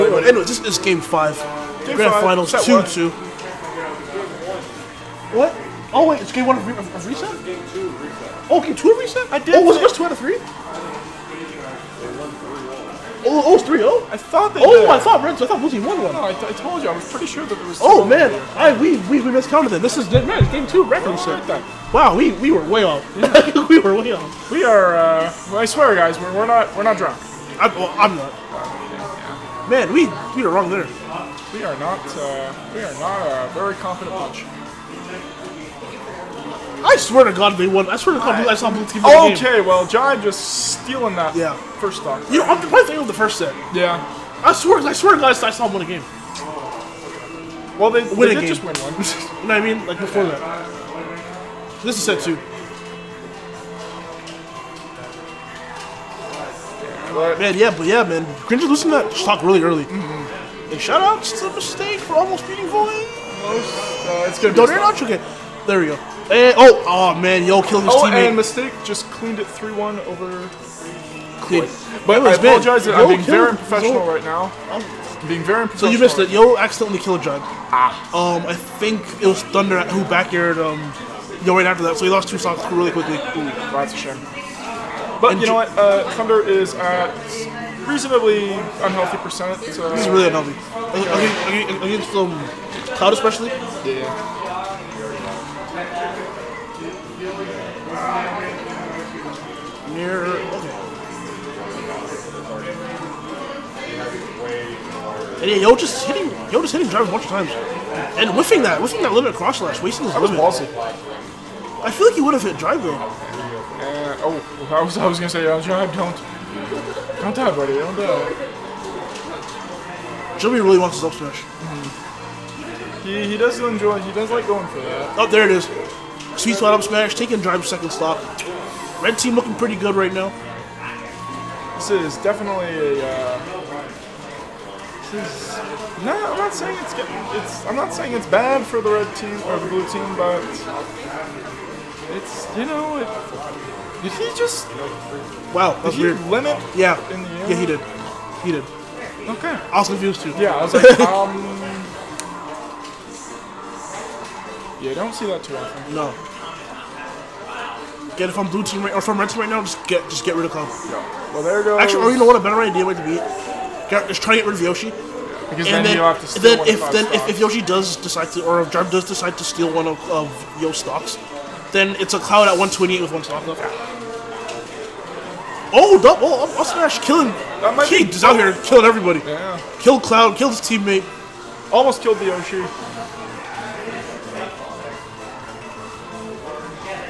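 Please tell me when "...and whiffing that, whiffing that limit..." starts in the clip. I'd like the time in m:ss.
1:48.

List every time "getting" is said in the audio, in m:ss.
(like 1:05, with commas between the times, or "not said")
2:16.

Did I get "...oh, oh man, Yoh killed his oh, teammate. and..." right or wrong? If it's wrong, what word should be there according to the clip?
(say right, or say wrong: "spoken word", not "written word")
right.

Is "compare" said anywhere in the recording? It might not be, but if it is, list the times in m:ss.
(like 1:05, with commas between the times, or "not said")
not said.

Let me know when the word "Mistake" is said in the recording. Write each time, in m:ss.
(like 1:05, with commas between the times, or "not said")
1:01, 1:08.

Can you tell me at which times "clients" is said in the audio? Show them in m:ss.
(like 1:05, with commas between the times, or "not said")
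not said.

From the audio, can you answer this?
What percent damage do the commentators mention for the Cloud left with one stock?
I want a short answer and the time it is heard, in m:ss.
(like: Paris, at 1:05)
128, at 2:52.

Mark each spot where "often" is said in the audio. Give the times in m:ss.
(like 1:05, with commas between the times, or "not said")
2:35.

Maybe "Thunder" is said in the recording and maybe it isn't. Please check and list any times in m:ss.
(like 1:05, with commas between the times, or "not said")
1:19, 1:26.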